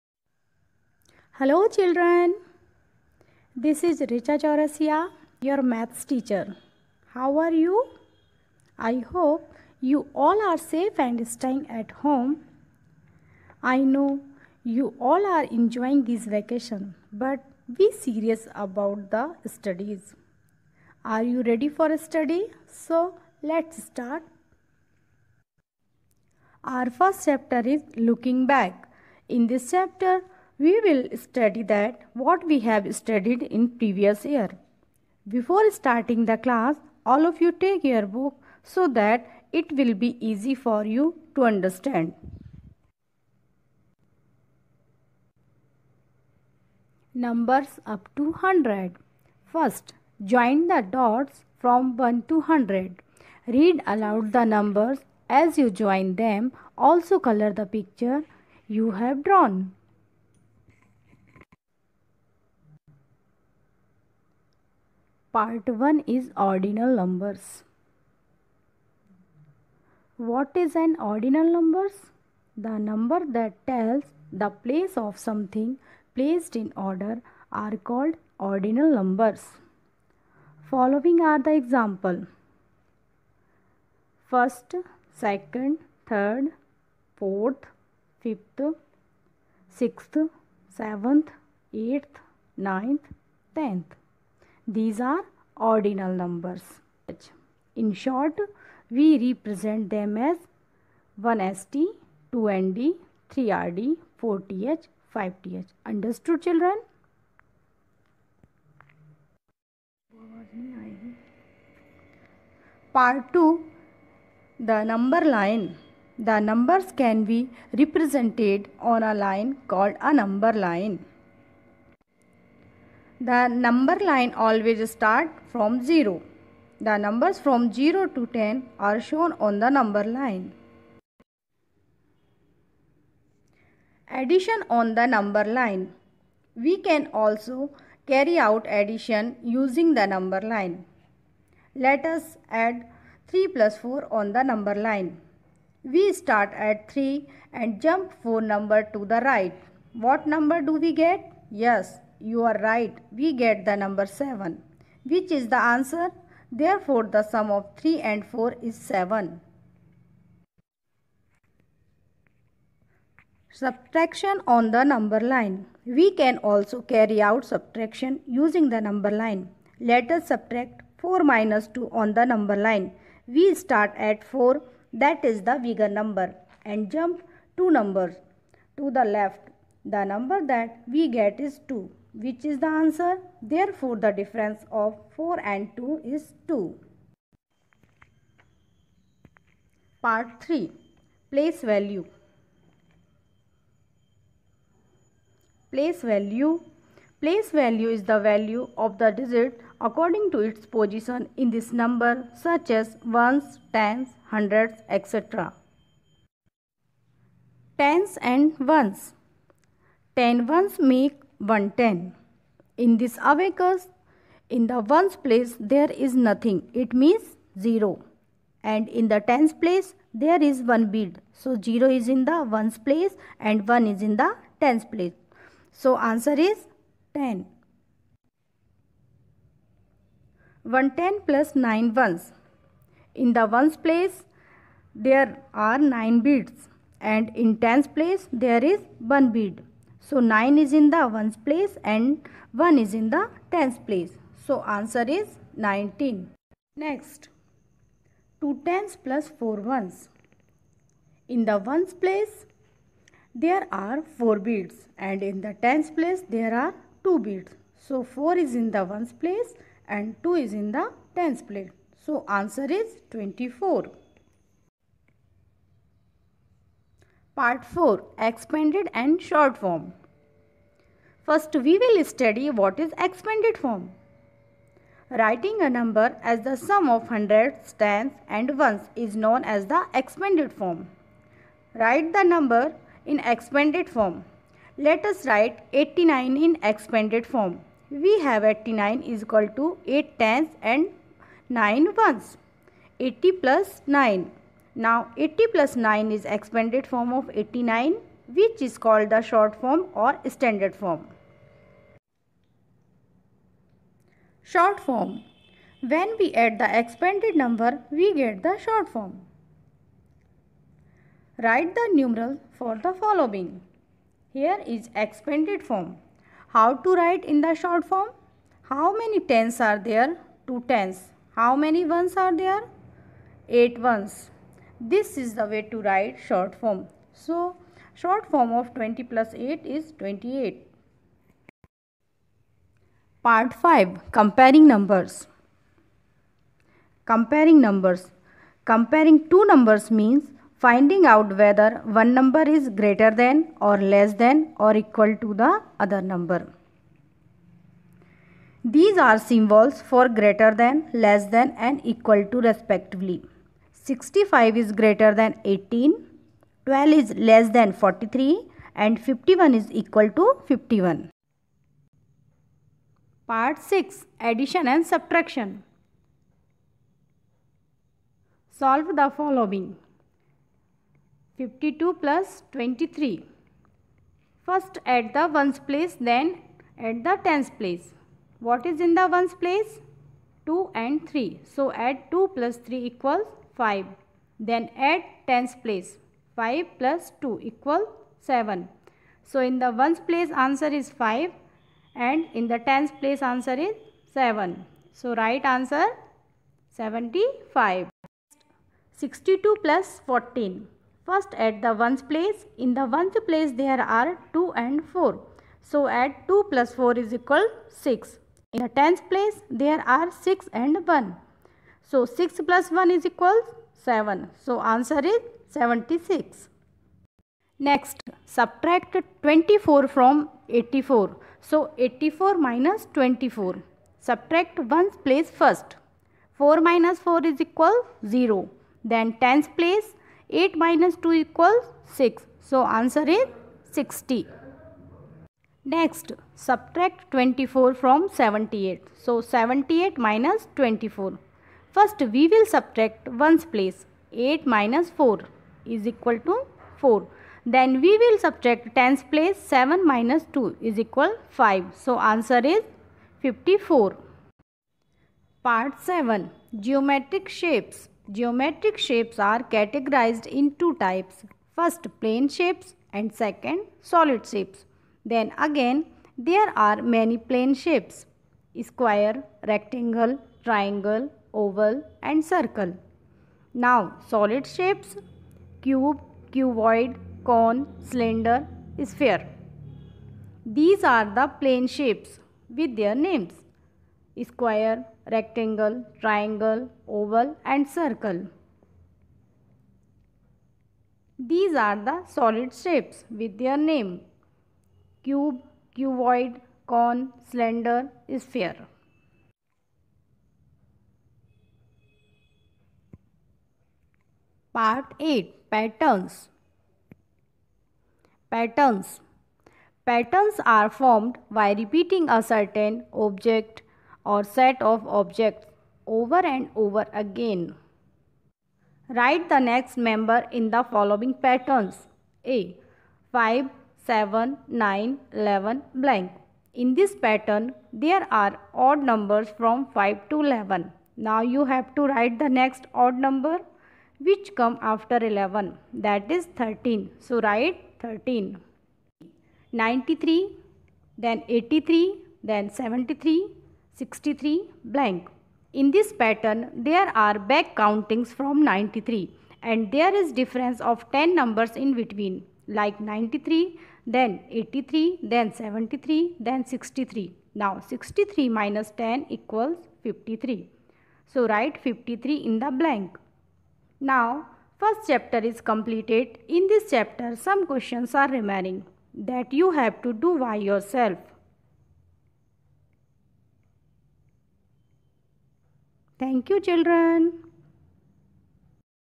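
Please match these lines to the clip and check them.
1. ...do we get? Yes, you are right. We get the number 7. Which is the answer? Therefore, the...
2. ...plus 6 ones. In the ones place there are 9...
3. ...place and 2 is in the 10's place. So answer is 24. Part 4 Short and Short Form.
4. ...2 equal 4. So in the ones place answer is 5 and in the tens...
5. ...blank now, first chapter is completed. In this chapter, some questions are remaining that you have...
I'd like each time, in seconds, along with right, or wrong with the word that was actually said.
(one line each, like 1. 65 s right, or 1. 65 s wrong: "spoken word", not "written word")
1. 150 s right
2. 231 s wrong: "9", not "6"
3. 259 s wrong: "Expanded", not "Short"
4. 387 s wrong: "7", not "4"
5. 562 s right.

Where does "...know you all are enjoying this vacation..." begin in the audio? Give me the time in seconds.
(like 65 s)
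13 s.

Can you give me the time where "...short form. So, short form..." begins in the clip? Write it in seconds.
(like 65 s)
326 s.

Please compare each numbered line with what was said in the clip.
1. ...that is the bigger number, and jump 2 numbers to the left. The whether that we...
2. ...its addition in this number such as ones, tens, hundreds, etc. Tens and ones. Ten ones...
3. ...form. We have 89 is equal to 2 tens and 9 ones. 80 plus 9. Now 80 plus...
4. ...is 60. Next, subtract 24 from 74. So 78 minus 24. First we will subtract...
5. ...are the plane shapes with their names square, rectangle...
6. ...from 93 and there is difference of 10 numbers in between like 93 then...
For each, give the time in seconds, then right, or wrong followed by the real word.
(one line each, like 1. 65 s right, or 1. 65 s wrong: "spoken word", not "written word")
1. 174 s wrong: "number", not "whether"
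2. 200 s wrong: "position", not "addition"
3. 287 s wrong: "8", not "2"
4. 433 s wrong: "78", not "74"
5. 480 s right
6. 548 s right.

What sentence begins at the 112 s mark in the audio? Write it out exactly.
Part 2 The number line The numbers can be represented on a line called a number line.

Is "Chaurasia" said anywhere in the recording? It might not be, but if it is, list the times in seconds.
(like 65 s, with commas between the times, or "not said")
4 s.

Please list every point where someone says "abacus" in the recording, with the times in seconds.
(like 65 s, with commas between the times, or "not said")
213 s.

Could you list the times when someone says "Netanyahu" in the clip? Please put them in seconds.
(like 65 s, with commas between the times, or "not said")
not said.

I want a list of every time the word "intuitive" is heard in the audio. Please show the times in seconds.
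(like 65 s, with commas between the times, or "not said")
not said.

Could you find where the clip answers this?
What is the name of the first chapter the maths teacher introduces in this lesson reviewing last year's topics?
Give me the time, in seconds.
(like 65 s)
27 s.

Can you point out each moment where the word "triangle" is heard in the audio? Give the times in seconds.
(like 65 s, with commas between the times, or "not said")
470 s, 485 s.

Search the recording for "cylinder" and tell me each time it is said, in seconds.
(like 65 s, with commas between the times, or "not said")
477 s, 497 s.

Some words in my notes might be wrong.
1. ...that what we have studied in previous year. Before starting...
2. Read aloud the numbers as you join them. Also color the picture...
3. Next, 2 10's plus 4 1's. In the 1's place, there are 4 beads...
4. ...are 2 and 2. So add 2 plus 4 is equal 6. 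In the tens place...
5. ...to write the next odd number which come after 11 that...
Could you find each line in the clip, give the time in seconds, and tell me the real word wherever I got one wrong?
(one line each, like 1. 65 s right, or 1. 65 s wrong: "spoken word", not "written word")
1. 31 s right
2. 53 s right
3. 246 s right
4. 404 s wrong: "4", not "2"
5. 531 s right.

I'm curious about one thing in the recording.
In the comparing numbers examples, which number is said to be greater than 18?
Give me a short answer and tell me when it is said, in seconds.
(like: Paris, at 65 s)
65, at 353 s.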